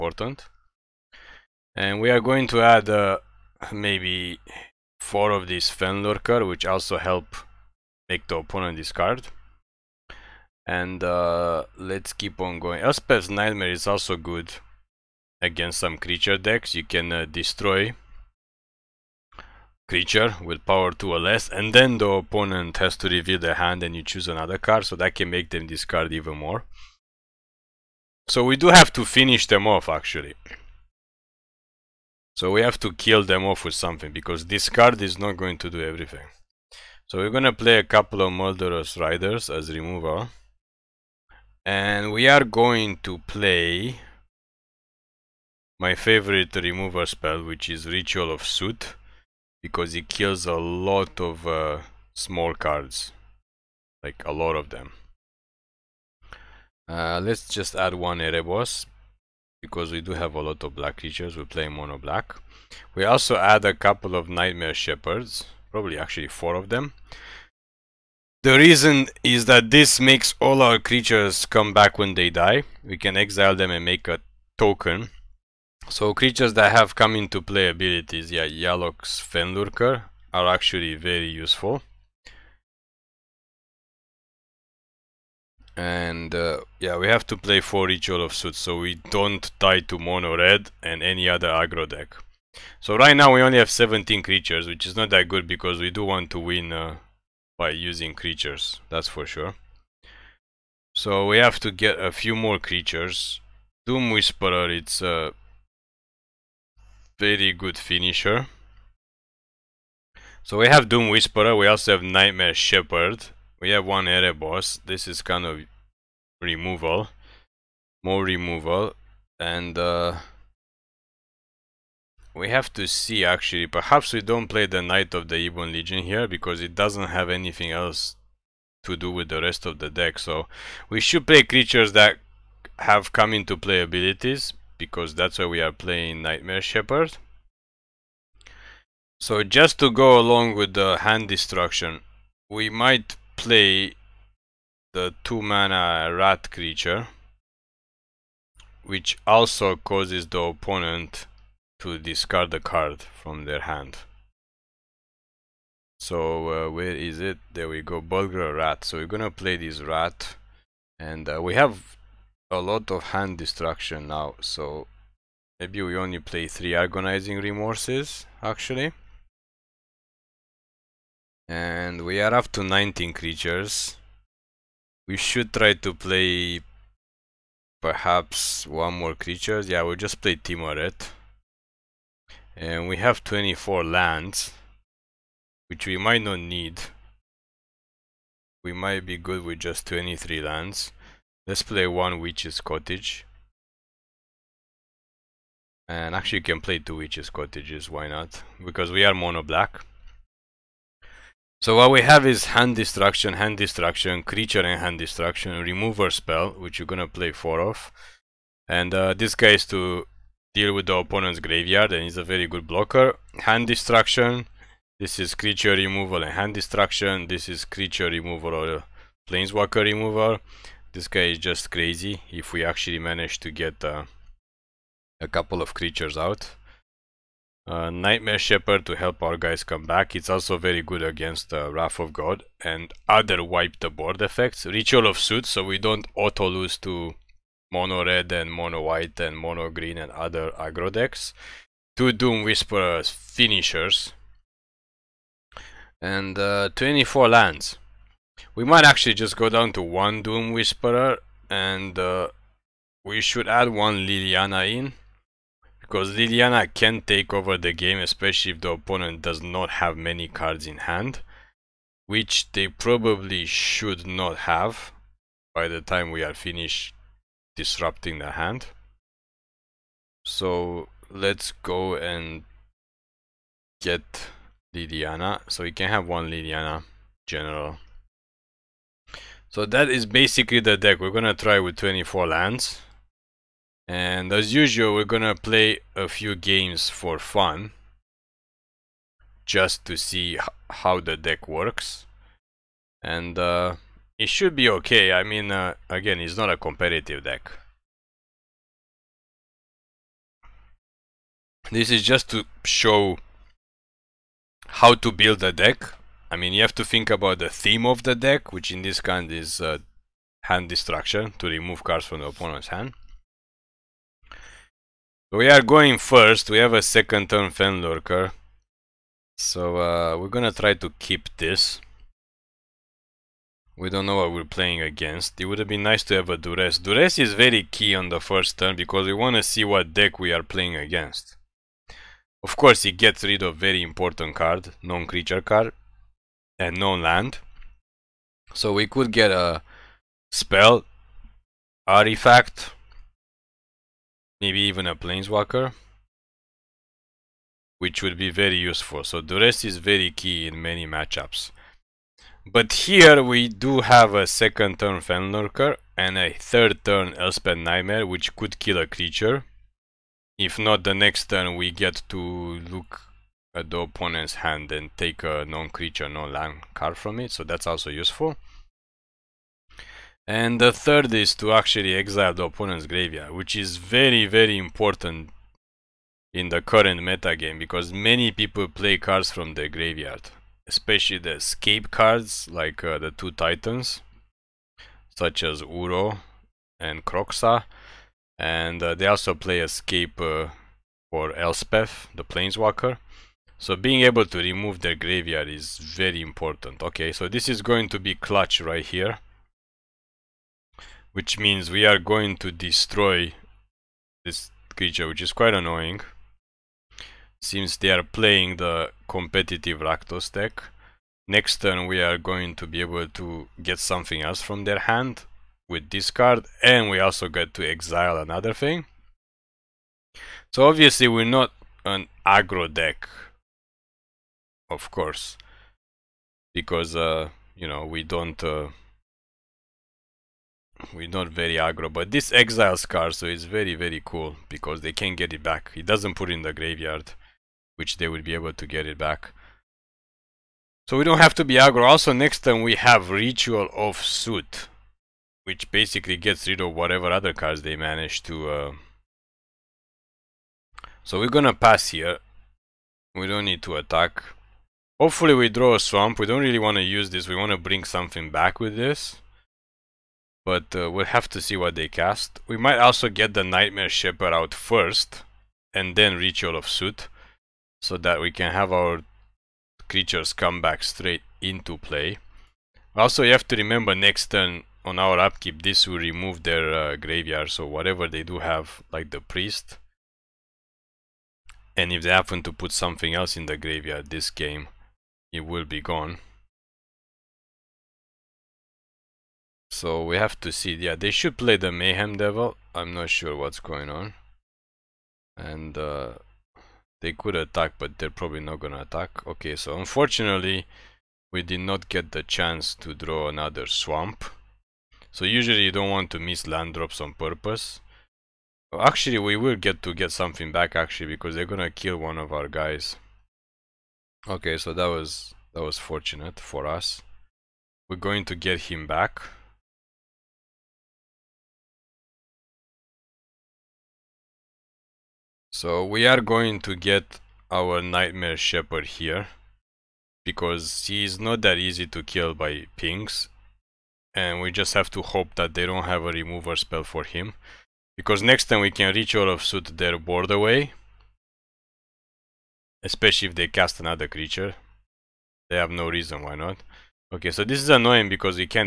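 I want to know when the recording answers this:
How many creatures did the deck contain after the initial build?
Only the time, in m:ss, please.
1:33.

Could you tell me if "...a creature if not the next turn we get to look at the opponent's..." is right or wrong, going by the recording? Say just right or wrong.
right.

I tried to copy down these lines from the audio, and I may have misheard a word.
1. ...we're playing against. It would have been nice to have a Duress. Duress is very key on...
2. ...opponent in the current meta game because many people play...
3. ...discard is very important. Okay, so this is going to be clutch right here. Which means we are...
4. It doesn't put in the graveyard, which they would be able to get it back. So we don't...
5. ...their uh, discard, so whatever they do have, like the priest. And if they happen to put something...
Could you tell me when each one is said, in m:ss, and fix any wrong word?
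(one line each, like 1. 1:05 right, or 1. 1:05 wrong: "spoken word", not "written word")
1. 5:24 right
2. 6:14 wrong: "important", not "opponent"
3. 6:34 wrong: "graveyard", not "discard"
4. 7:15 right
5. 7:56 wrong: "graveyard", not "discard".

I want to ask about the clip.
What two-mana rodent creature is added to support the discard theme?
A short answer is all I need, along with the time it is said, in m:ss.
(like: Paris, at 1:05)
Burglar Rat, at 2:38.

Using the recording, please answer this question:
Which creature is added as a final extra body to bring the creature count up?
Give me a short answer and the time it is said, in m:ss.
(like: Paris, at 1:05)
Tymaret, at 3:00.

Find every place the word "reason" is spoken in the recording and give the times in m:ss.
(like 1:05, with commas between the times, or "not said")
1:08, 9:05.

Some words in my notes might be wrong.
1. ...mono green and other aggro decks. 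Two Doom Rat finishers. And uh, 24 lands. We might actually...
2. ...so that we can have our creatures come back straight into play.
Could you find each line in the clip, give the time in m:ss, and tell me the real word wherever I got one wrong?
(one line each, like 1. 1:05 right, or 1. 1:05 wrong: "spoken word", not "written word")
1. 3:59 wrong: "Whisperers", not "Rat"
2. 7:47 right.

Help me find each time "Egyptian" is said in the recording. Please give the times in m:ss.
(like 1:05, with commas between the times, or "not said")
not said.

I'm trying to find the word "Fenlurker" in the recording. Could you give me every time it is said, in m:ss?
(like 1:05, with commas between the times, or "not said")
0:05, 1:19, 5:17, 5:54.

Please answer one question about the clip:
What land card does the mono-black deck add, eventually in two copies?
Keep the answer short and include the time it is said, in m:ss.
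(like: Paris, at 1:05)
Witch's Cottage, at 3:12.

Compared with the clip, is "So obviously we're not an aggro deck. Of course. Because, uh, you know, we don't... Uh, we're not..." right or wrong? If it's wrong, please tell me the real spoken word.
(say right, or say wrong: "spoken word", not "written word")
right.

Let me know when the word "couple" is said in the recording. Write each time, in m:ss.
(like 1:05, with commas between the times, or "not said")
0:37, 1:03, 3:45.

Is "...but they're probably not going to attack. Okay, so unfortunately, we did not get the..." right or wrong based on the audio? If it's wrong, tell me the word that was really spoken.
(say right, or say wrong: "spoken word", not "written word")
right.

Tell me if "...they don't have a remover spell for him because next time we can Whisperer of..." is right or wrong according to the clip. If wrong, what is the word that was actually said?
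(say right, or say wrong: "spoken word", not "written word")
wrong: "Ritual", not "Whisperer".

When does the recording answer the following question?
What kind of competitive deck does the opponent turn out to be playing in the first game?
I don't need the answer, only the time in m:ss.
6:49.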